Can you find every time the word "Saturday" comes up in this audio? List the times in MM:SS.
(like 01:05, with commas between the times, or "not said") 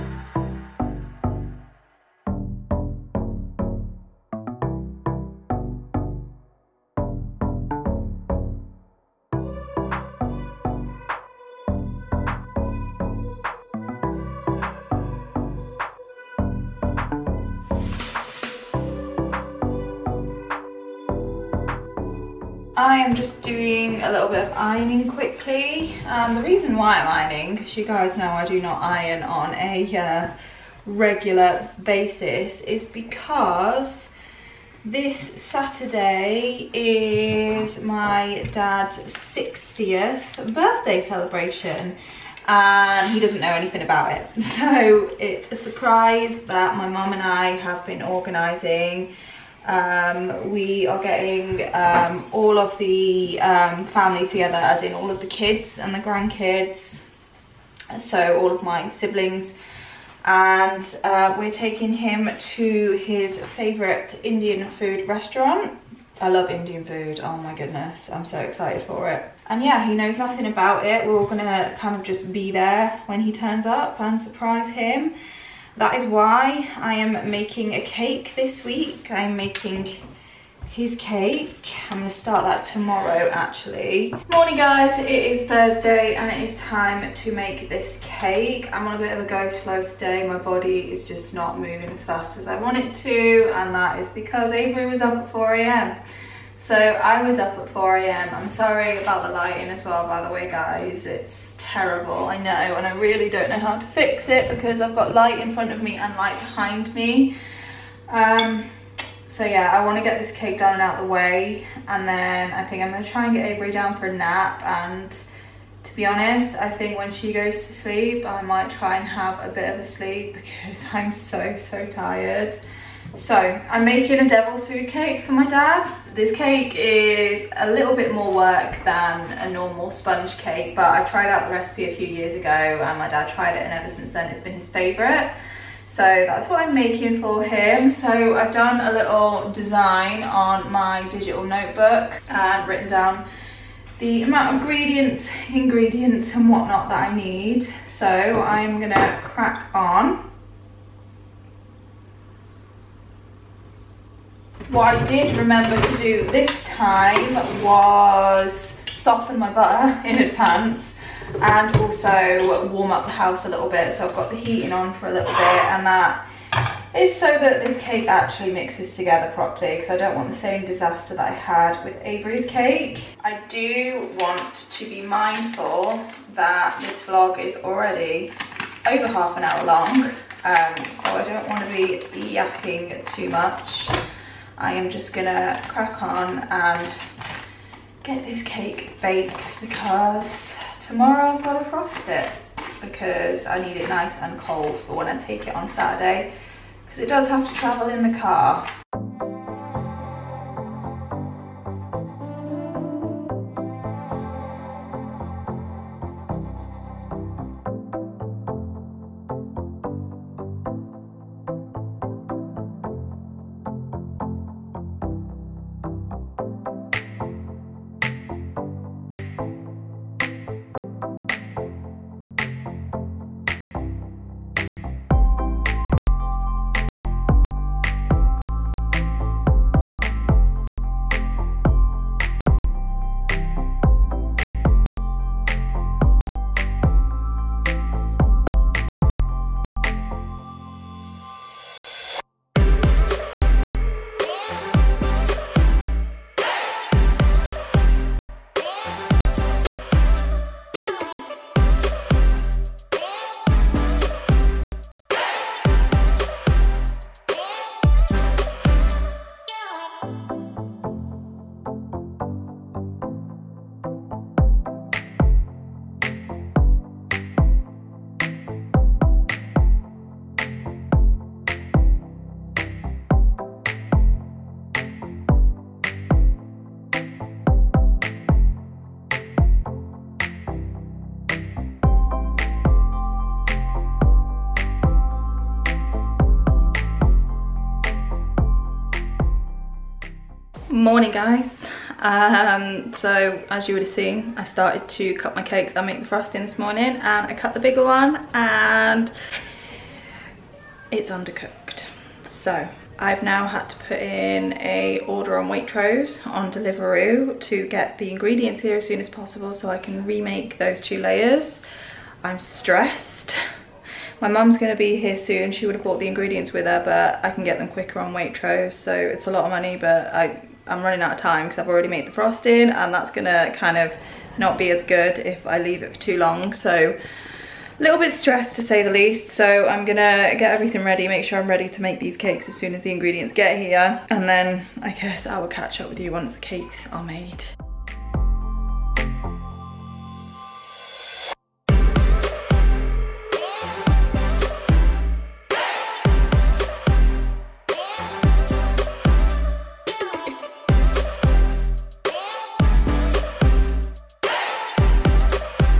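00:35, 03:15.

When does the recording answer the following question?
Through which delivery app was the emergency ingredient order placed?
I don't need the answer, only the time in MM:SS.
05:06.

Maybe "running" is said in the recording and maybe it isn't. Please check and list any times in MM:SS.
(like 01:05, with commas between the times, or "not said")
05:20.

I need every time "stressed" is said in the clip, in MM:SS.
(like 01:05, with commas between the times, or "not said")
05:12, 05:28.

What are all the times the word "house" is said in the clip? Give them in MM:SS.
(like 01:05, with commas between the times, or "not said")
02:43.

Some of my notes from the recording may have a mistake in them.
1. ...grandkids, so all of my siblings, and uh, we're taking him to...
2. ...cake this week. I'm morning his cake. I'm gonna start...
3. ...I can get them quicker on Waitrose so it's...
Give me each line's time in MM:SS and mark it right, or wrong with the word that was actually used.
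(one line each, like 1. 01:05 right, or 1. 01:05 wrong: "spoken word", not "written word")
1. 00:55 right
2. 01:17 wrong: "making", not "morning"
3. 05:17 right.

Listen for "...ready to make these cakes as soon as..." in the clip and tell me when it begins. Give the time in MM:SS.
05:31.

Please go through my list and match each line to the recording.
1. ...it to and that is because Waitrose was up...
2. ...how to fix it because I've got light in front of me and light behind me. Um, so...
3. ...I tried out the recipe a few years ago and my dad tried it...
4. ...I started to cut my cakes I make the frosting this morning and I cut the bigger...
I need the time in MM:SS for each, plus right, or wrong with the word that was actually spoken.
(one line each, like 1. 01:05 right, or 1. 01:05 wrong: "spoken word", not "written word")
1. 01:32 wrong: "Avery", not "Waitrose"
2. 01:43 right
3. 02:10 right
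4. 04:54 right.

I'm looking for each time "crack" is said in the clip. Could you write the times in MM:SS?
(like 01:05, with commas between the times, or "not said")
02:29, 03:05.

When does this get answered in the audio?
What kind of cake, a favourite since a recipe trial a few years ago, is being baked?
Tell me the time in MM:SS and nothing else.
02:04.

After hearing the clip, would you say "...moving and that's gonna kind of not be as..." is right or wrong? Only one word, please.
wrong.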